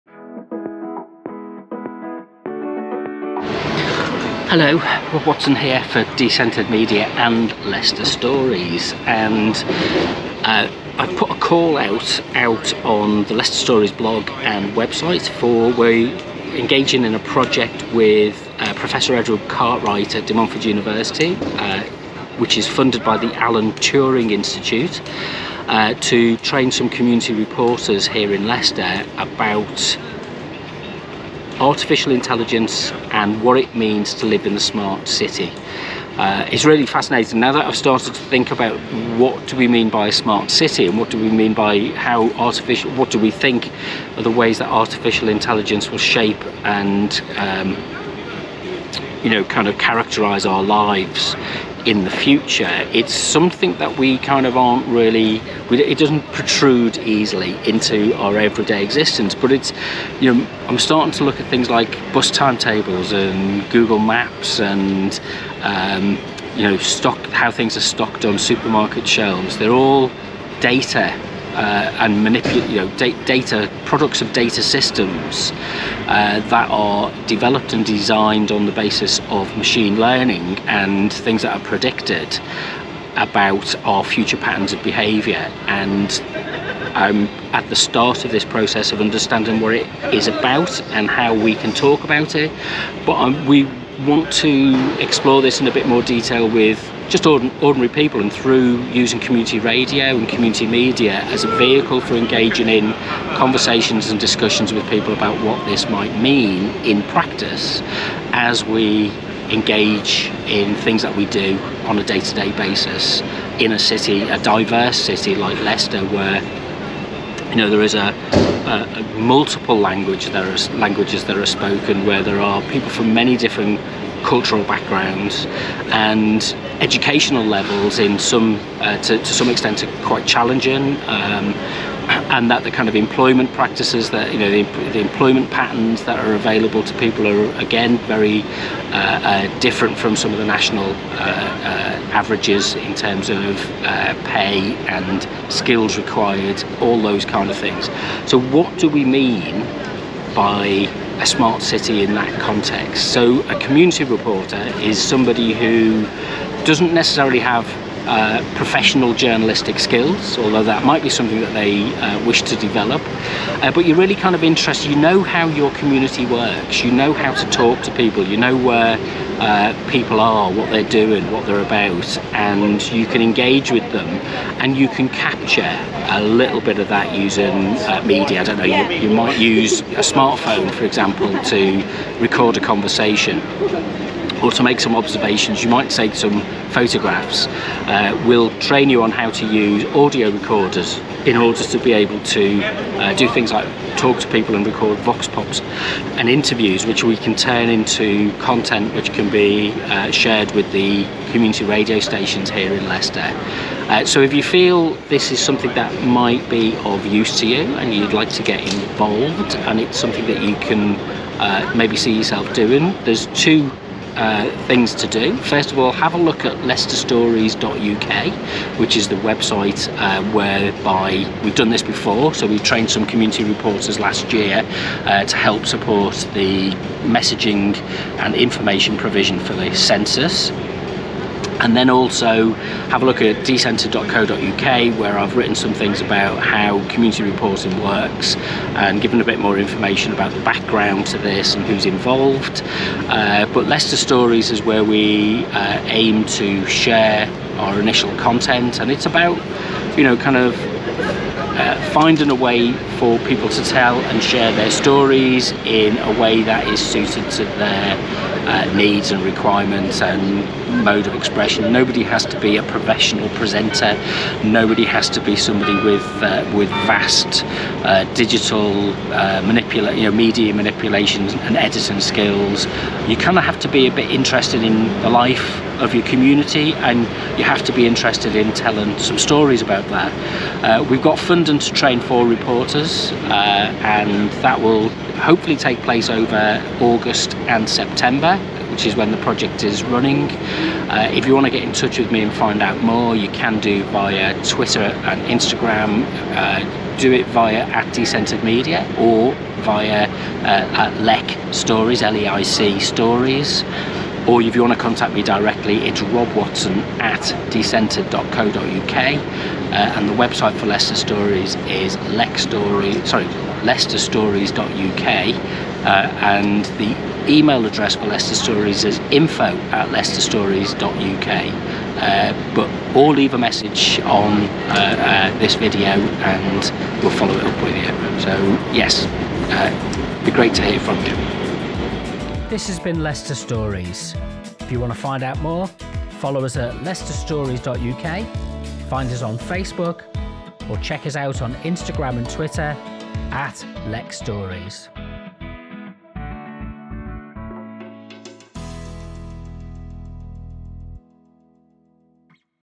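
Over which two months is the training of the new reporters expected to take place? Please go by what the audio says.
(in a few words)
August and September.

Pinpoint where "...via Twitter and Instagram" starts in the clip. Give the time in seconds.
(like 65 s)
293 s.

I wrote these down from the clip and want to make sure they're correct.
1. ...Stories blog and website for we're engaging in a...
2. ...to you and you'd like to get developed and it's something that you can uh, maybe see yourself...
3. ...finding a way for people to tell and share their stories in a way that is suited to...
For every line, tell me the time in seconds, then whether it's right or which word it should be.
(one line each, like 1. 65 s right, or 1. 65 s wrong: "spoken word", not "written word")
1. 13 s right
2. 207 s wrong: "involved", not "developed"
3. 251 s right.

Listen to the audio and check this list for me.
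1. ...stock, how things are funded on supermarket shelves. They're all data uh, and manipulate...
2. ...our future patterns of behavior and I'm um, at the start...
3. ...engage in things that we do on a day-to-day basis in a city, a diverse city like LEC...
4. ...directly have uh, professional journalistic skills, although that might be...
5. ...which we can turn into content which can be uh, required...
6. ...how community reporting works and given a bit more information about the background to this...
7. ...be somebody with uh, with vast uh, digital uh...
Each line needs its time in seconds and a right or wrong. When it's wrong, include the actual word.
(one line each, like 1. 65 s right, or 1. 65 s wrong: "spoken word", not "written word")
1. 66 s wrong: "stocked", not "funded"
2. 83 s right
3. 109 s wrong: "Leicester", not "LEC"
4. 156 s wrong: "necessarily", not "directly"
5. 196 s wrong: "shared", not "required"
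6. 236 s right
7. 265 s right.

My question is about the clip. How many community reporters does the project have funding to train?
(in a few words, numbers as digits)
4.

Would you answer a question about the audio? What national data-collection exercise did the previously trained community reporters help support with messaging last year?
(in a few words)
The census.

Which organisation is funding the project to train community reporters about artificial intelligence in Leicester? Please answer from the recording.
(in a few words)
Alan Turing Institute.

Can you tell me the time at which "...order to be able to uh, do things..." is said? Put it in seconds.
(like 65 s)
191 s.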